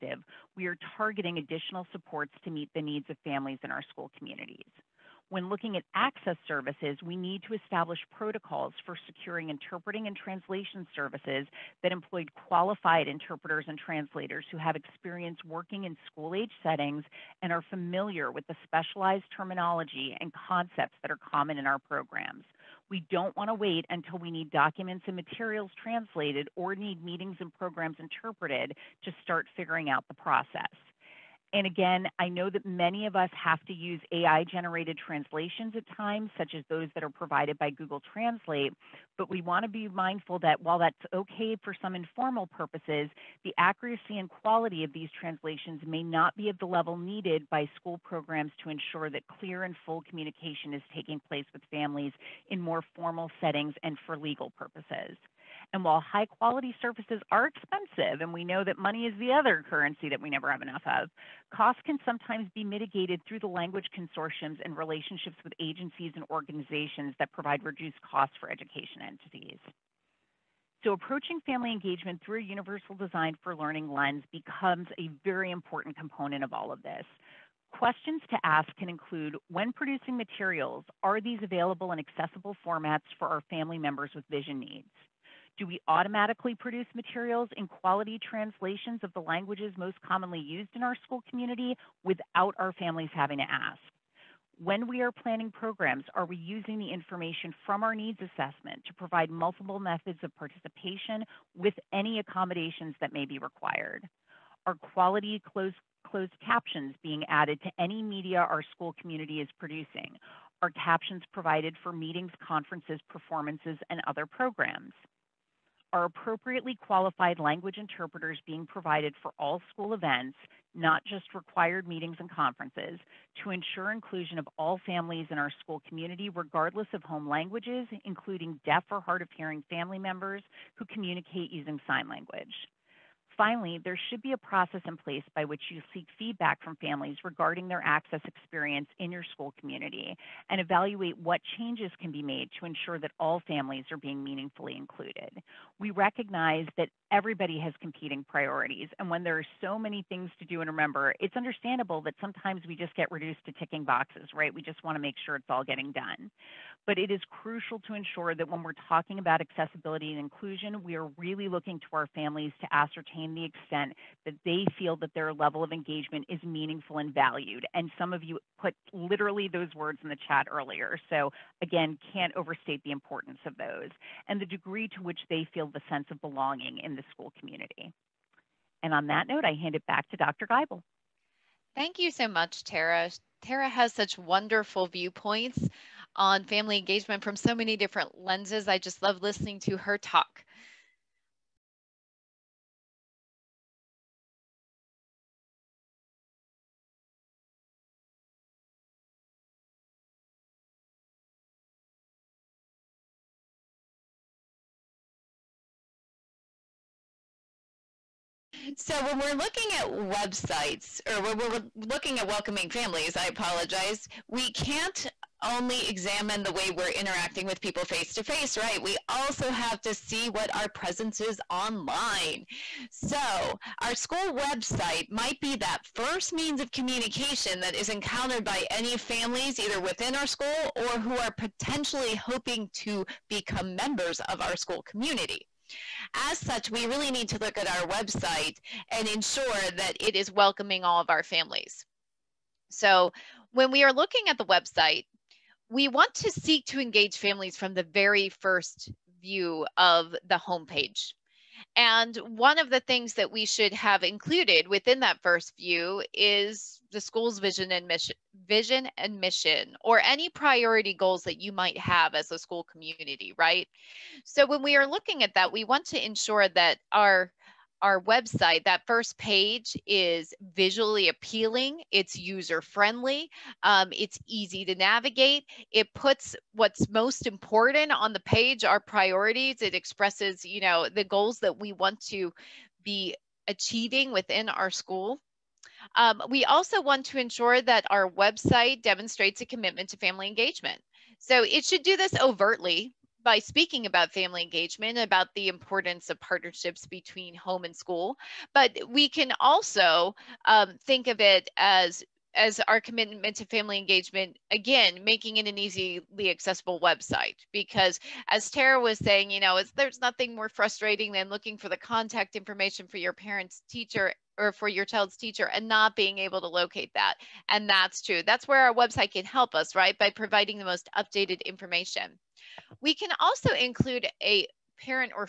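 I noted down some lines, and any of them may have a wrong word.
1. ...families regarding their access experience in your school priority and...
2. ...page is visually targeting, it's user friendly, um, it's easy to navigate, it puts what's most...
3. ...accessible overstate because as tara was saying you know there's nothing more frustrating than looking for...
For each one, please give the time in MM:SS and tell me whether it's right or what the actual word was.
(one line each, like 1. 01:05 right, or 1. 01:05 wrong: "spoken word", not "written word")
1. 02:16 wrong: "community", not "priority"
2. 04:29 wrong: "appealing", not "targeting"
3. 05:06 wrong: "website", not "overstate".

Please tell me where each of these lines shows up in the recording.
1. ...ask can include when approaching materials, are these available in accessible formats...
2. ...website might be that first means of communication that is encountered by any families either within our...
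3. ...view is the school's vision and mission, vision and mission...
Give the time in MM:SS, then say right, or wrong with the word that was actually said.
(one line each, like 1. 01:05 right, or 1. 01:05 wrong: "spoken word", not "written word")
1. 01:18 wrong: "producing", not "approaching"
2. 03:44 right
3. 04:15 right.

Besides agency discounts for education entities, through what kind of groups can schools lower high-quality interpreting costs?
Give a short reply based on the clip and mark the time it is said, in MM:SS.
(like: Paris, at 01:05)
language consortiums, at 01:03.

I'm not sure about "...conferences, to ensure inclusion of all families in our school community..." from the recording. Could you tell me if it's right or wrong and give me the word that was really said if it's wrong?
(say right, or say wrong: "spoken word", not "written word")
right.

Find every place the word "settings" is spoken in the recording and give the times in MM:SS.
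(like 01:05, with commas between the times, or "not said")
00:16, 00:53.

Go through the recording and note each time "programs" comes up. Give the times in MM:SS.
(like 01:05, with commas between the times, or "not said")
00:21, 00:27, 00:48, 01:35, 01:54.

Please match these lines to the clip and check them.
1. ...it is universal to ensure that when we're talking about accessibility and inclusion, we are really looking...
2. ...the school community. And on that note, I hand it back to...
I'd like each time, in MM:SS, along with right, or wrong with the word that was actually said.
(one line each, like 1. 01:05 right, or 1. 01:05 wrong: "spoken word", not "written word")
1. 02:36 wrong: "crucial", not "universal"
2. 02:56 right.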